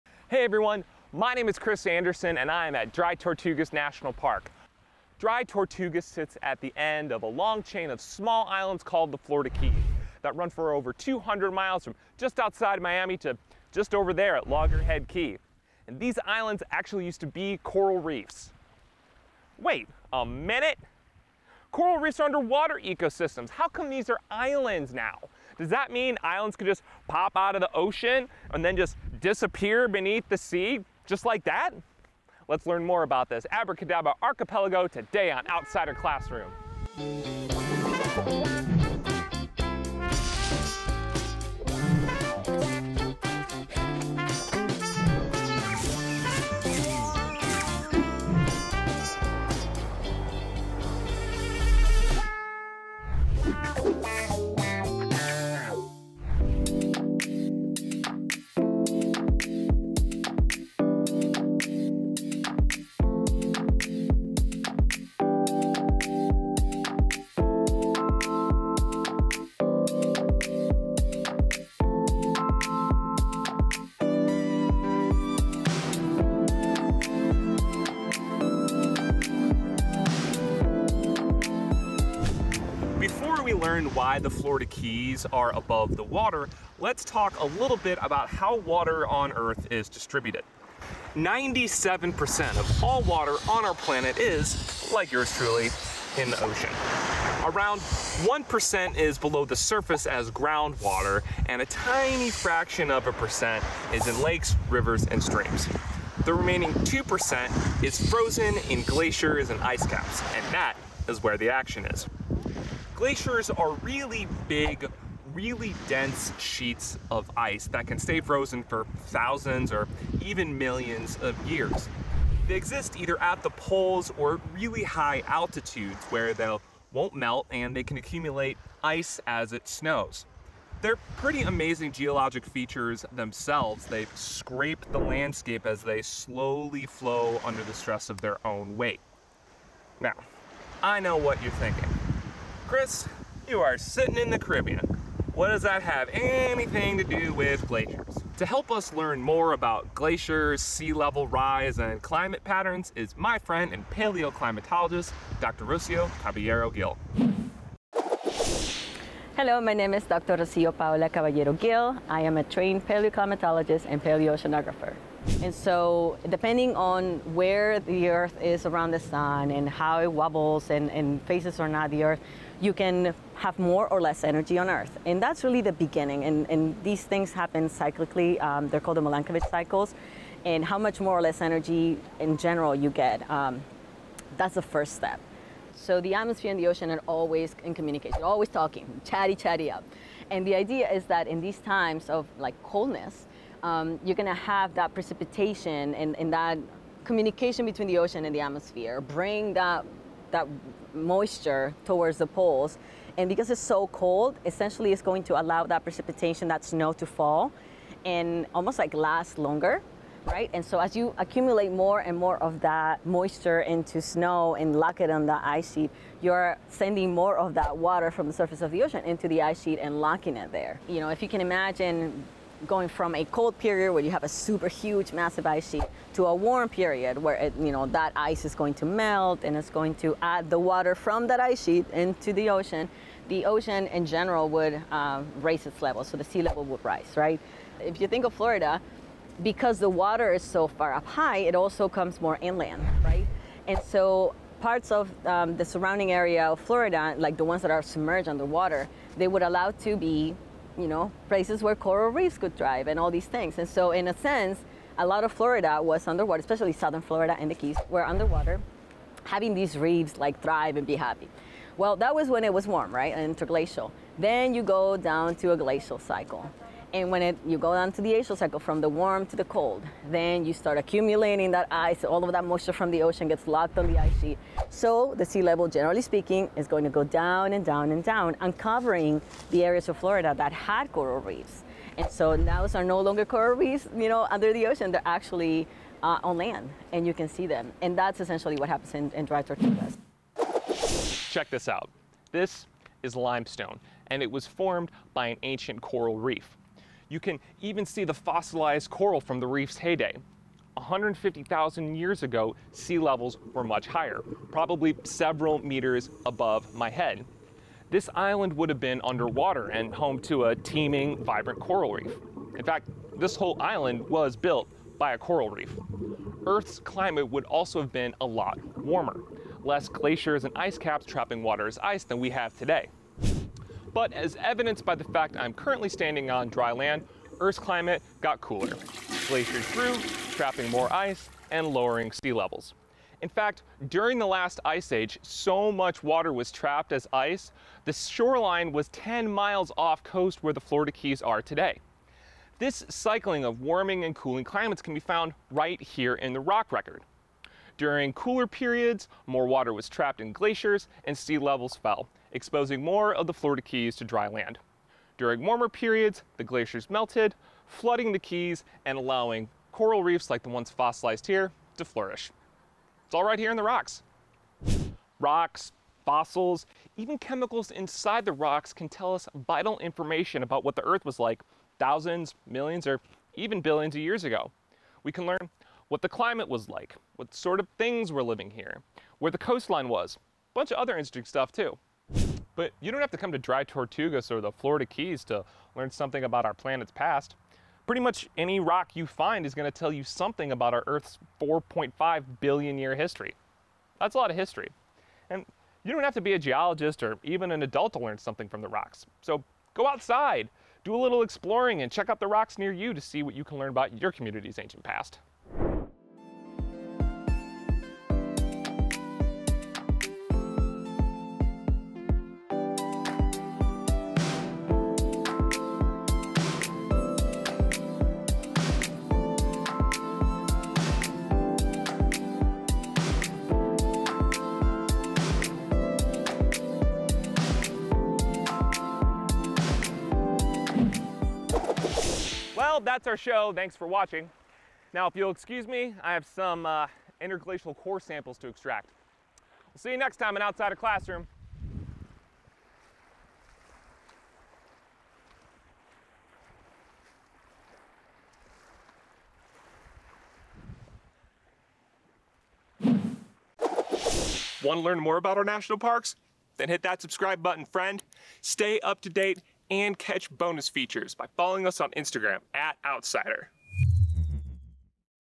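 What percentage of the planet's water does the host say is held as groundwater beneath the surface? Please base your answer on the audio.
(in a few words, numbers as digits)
1%.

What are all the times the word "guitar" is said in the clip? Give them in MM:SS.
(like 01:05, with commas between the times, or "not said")
not said.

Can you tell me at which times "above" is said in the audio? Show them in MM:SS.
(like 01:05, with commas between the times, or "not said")
01:25, 05:06.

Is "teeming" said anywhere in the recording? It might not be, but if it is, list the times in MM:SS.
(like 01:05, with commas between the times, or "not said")
05:10.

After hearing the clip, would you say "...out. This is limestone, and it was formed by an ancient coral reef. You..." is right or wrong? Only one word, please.
right.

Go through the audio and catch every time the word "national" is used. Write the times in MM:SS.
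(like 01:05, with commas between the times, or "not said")
00:03, 07:35.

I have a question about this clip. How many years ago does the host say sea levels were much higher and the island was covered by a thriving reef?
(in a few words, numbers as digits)
150,000.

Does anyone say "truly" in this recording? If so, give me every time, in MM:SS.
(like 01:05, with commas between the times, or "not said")
01:35.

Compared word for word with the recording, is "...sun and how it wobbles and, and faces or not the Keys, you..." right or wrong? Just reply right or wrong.
wrong.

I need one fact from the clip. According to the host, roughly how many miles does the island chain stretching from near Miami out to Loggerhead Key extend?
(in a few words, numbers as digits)
over 200 miles.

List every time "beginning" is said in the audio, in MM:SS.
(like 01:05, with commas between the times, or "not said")
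02:55.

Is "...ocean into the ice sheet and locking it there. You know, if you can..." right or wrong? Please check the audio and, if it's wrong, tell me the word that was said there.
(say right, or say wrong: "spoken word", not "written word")
right.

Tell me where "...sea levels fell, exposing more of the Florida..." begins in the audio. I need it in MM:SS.
05:51.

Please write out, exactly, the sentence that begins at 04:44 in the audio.
They're actually uh, on land, and you can see them.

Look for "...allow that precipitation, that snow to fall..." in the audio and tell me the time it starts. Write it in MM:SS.
03:25.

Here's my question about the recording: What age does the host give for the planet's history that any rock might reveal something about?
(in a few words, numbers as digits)
4.5 billion years.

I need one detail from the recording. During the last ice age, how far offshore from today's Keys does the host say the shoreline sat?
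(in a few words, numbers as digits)
10 miles.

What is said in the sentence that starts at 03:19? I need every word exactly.
Bring that that moisture towards the poles.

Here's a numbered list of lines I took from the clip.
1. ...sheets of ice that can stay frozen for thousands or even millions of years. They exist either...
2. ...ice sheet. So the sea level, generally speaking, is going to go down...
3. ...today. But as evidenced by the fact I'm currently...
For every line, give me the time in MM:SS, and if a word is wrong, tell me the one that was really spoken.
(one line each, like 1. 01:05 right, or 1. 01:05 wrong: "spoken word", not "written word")
1. 01:56 right
2. 04:33 right
3. 05:22 right.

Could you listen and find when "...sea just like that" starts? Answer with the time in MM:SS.
00:30.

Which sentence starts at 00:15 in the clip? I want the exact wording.
And these islands actually used to be coral reefs.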